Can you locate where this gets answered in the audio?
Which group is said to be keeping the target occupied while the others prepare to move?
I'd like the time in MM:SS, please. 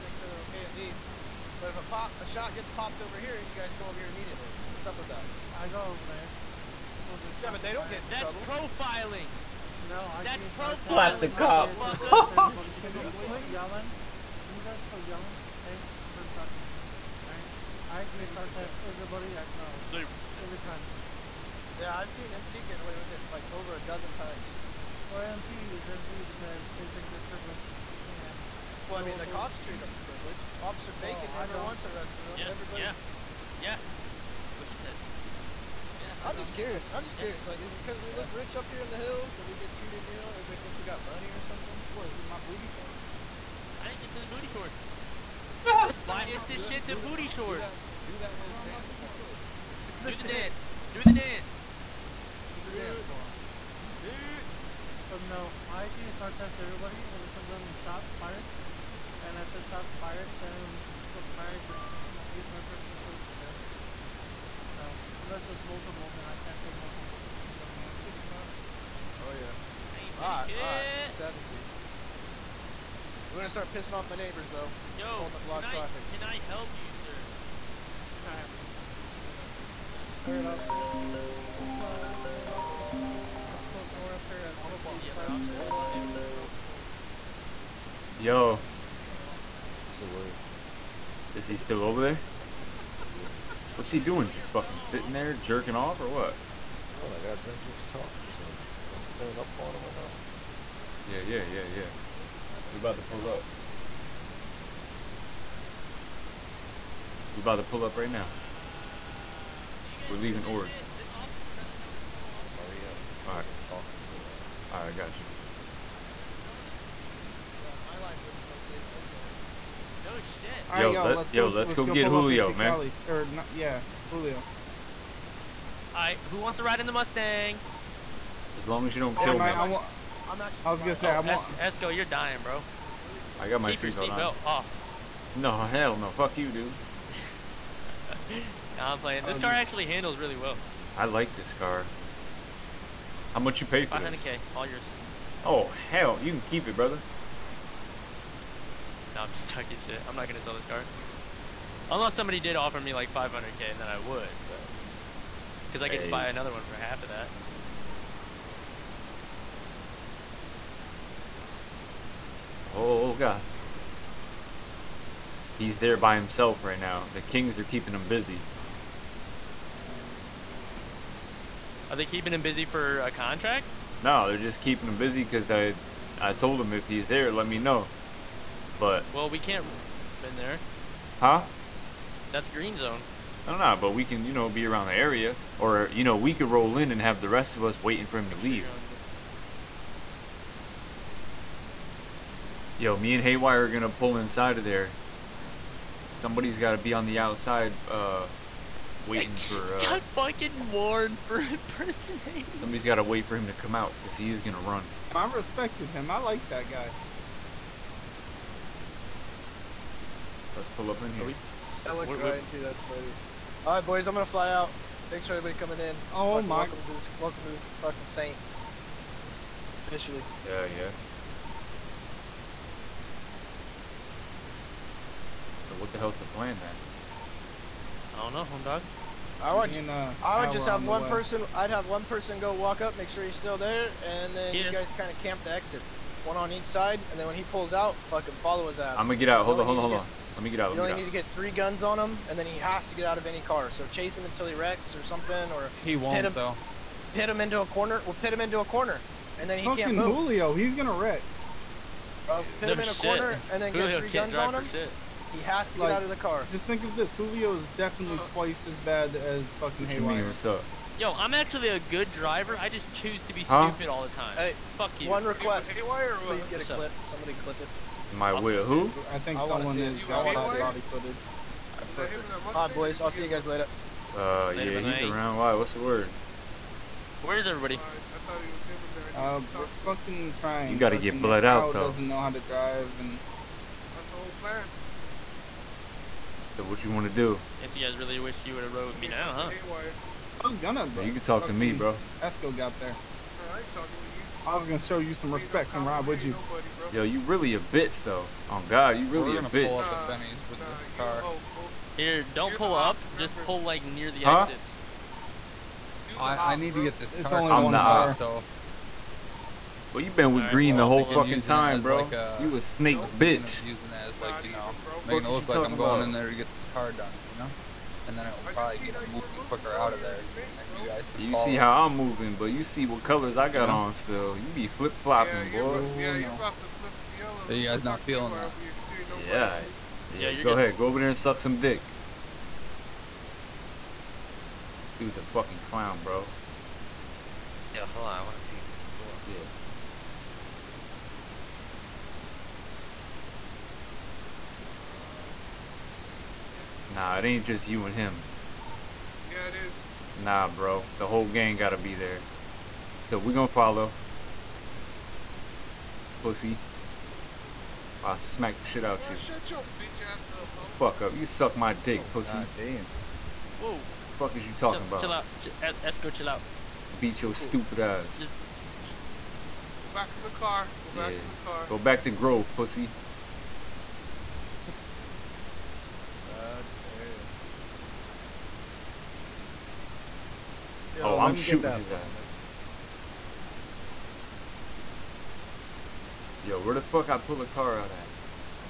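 02:47.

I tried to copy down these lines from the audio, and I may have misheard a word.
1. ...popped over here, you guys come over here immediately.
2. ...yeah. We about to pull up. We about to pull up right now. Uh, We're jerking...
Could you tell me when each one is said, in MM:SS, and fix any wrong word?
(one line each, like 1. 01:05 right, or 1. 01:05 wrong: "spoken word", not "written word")
1. 00:02 right
2. 01:41 wrong: "leaving", not "jerking".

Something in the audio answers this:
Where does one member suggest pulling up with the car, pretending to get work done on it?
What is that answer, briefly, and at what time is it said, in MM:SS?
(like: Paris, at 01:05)
Benny's, at 05:00.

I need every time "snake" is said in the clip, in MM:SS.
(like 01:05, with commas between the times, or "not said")
05:12, 05:20.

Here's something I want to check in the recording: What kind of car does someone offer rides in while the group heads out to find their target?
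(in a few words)
Mustang.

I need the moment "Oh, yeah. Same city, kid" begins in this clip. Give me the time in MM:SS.
01:09.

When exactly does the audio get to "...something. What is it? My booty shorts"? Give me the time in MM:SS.
00:41.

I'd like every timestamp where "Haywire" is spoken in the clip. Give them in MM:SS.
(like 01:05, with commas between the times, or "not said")
03:13, 04:19, 04:25.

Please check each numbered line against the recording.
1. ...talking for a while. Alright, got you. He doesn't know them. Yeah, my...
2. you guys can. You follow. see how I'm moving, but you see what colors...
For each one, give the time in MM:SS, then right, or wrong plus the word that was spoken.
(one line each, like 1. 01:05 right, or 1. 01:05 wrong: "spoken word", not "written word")
1. 01:53 right
2. 05:20 right.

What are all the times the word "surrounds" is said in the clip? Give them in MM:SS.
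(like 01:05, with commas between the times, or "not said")
not said.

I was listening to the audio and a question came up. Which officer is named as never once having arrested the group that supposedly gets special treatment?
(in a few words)
Officer Bacon.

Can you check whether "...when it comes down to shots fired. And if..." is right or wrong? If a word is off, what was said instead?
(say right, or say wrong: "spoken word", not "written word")
right.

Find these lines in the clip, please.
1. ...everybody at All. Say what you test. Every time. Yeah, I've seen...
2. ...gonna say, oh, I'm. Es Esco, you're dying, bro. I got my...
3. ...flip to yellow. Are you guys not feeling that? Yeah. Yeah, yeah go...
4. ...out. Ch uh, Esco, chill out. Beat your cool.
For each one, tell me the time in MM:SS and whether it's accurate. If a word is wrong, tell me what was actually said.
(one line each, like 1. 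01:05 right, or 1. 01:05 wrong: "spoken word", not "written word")
1. 00:18 wrong: "Grove", not "All"
2. 02:10 right
3. 05:26 right
4. 06:05 right.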